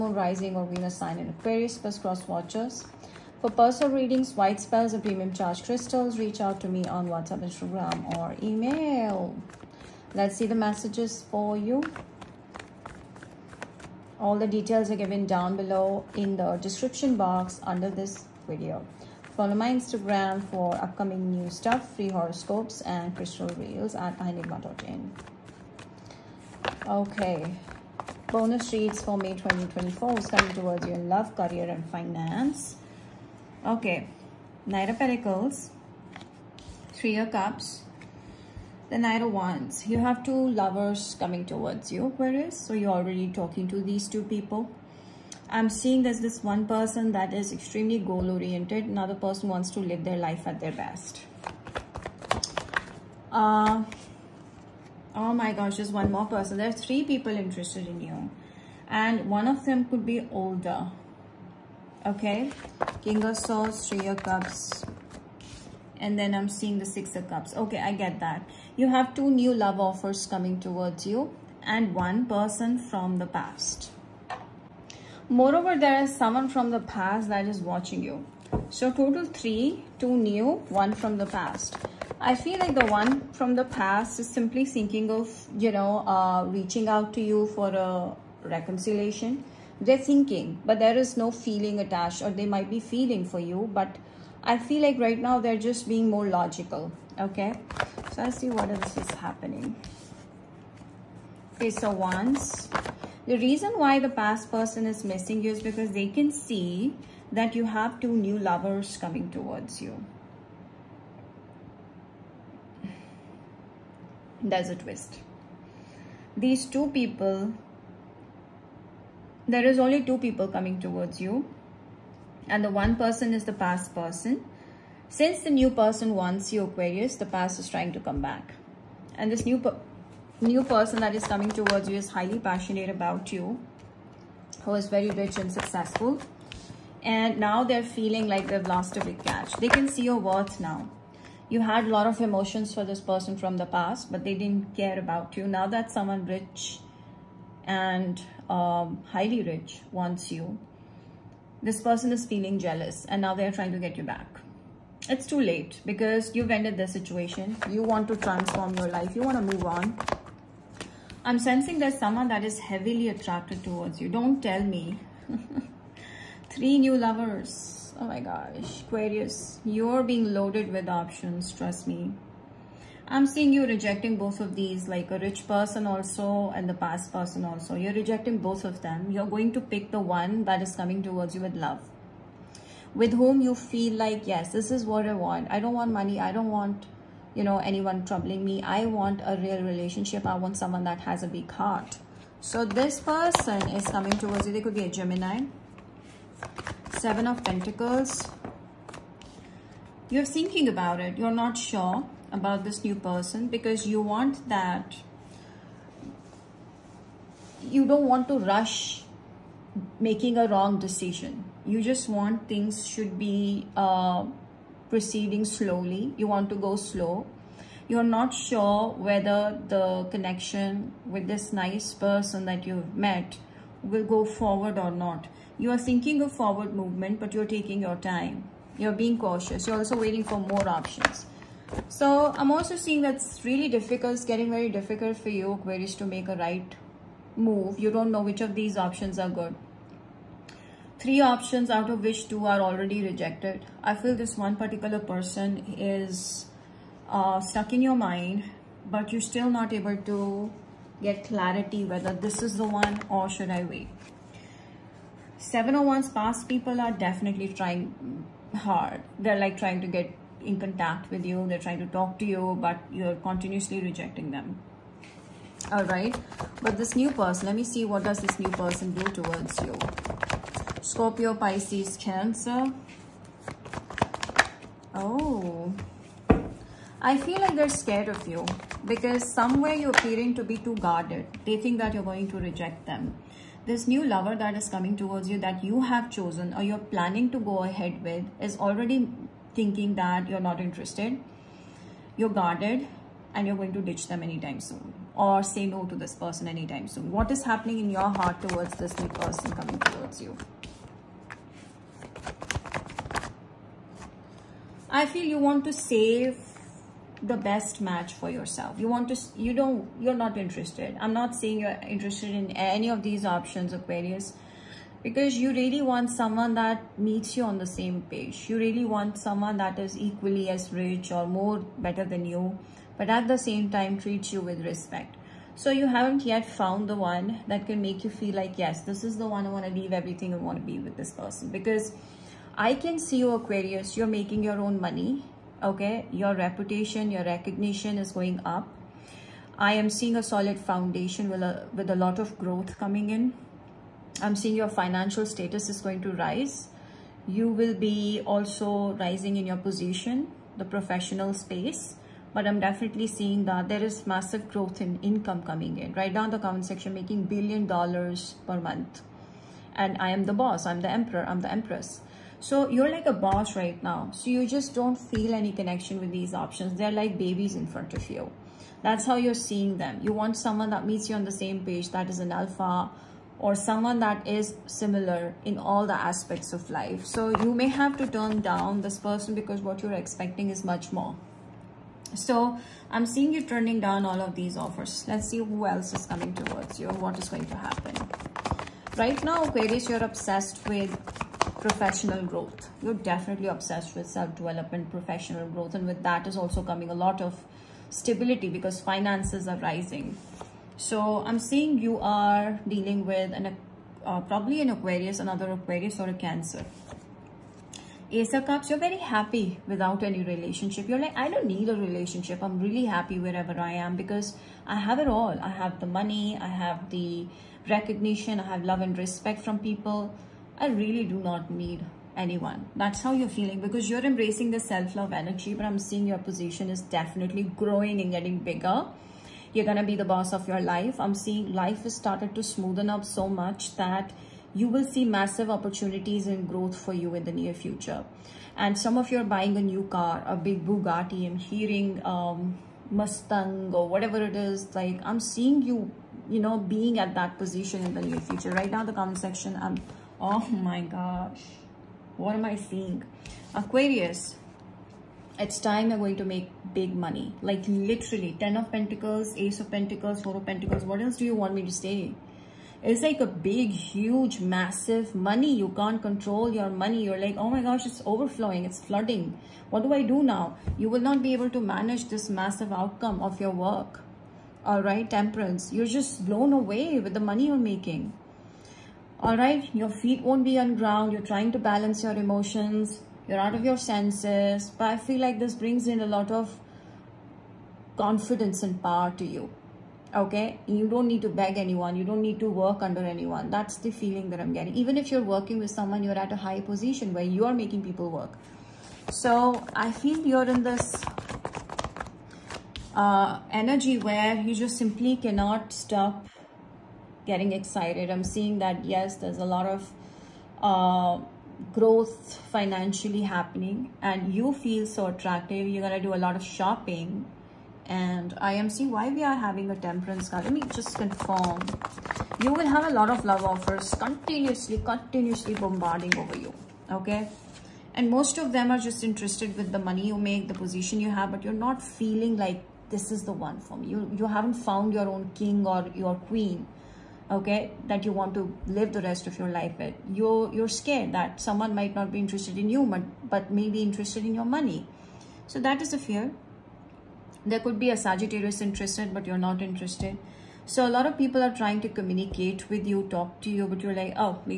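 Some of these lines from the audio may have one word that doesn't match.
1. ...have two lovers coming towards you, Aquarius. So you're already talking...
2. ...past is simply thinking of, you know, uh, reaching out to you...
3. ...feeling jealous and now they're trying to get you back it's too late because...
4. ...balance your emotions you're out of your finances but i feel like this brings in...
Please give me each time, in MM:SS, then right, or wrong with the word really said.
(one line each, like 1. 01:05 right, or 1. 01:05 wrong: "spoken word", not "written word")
1. 00:39 right
2. 01:23 right
3. 02:32 right
4. 08:01 wrong: "senses", not "finances".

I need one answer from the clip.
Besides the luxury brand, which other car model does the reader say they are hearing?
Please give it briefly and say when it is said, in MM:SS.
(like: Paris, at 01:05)
Mustang, at 07:22.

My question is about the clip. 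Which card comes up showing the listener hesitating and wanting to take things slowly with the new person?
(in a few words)
Seven of Pentacles.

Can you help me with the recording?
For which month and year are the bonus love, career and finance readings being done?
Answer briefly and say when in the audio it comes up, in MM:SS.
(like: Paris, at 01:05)
May 2024, at 00:29.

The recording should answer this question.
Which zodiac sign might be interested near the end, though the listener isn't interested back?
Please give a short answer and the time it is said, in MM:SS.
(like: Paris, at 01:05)
Sagittarius, at 09:08.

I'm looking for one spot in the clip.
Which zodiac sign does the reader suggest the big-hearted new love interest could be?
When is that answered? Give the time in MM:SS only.
03:14.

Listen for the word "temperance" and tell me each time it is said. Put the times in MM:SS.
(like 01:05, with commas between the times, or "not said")
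07:55, 08:39.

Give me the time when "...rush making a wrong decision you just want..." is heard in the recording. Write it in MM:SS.
03:28.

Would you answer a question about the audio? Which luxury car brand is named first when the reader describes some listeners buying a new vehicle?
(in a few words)
Bugatti.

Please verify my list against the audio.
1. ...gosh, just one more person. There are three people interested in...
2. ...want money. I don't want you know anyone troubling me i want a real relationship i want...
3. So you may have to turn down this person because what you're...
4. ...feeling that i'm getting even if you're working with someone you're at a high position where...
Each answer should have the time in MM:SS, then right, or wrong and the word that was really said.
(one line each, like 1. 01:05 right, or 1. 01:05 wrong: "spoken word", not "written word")
1. 00:55 right
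2. 03:05 right
3. 06:17 right
4. 08:13 right.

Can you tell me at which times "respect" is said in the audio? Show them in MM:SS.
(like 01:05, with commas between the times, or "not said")
05:24, 06:58.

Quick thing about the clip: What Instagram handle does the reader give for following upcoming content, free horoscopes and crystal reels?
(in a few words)
enigma.in.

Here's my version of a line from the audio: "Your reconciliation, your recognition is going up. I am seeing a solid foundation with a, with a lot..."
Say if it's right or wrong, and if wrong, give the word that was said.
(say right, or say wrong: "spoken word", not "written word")
wrong: "reputation", not "reconciliation".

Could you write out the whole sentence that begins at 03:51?
So I'm also seeing that's really difficult.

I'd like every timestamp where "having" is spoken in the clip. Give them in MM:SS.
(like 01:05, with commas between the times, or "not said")
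08:39.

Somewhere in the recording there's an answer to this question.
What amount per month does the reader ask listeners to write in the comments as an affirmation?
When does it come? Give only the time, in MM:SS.
05:57.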